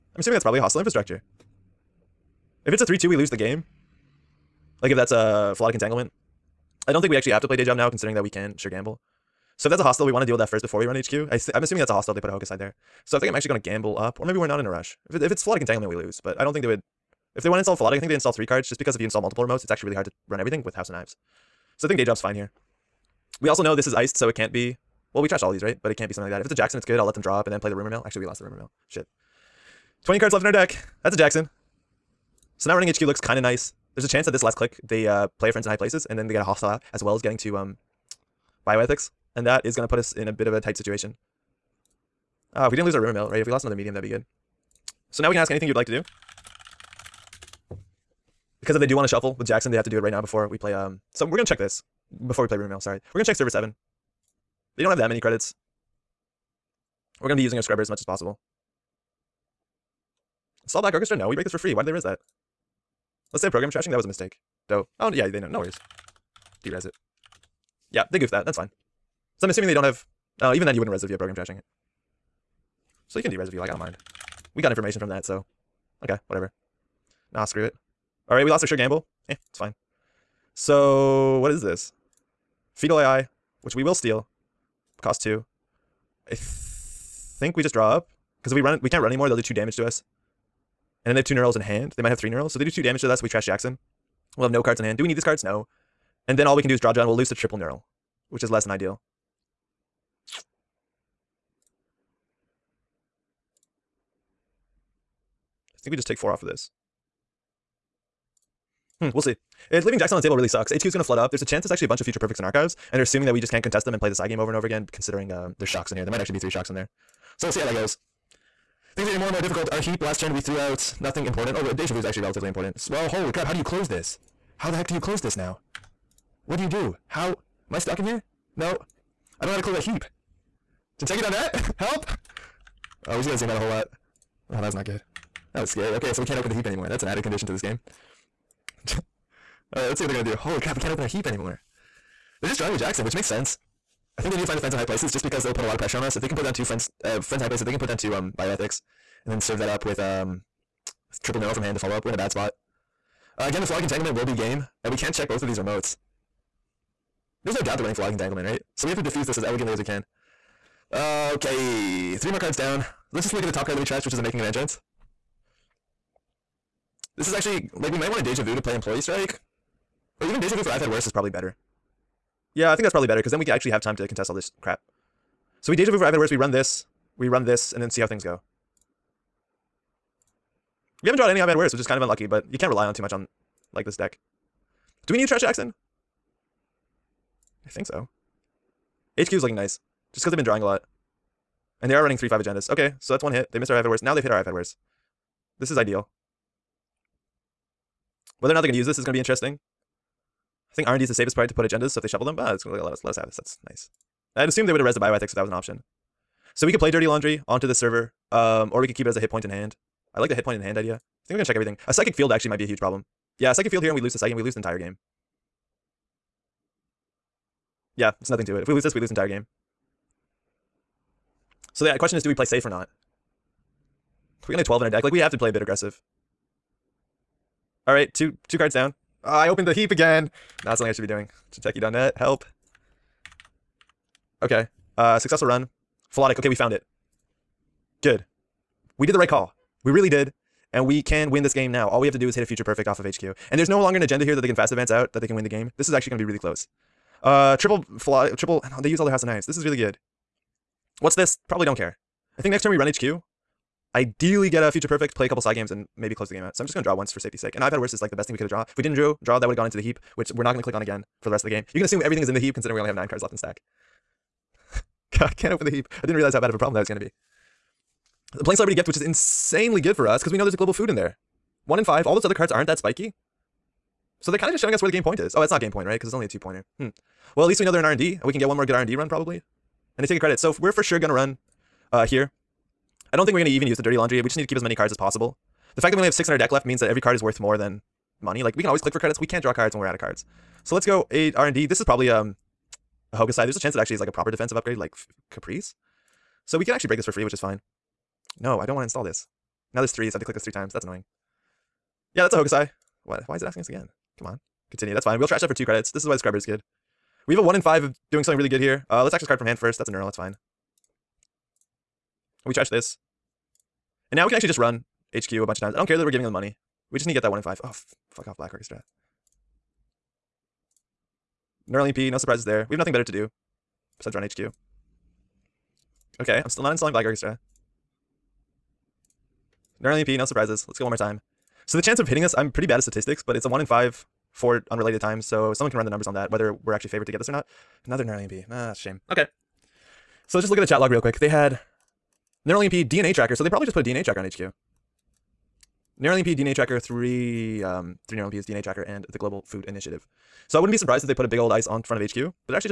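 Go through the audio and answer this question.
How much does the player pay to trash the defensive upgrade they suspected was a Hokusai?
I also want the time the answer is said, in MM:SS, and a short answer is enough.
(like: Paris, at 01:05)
2 credits, at 05:05.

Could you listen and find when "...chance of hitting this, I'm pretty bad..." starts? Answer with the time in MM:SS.
05:31.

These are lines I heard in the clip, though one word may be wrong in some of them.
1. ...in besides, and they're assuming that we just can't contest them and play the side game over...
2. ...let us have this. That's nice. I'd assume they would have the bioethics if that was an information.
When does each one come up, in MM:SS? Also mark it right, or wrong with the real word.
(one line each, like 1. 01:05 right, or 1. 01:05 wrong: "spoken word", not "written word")
1. 01:52 wrong: "archives", not "besides"
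2. 03:23 wrong: "option", not "information".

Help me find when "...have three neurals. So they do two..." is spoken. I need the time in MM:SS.
01:32.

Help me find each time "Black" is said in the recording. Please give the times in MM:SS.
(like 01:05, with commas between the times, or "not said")
01:00, 05:18, 05:26.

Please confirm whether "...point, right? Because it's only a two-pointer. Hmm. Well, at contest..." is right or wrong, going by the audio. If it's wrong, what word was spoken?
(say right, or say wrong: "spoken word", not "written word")
wrong: "least", not "contest".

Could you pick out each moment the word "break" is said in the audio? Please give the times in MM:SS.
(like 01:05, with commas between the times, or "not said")
01:01, 04:56.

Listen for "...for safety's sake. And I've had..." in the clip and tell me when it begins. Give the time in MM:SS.
04:17.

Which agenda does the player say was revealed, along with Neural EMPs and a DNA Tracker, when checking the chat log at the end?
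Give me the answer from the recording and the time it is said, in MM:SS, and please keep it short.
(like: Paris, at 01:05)
Global Food Initiative, at 05:49.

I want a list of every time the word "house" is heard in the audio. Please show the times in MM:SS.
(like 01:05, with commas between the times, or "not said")
00:20, 04:09.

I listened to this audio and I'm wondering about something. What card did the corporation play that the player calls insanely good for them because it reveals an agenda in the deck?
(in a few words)
Celebrity Gift.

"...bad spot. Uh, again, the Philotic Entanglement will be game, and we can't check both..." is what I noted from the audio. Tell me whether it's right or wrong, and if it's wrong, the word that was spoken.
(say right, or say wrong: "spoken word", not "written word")
right.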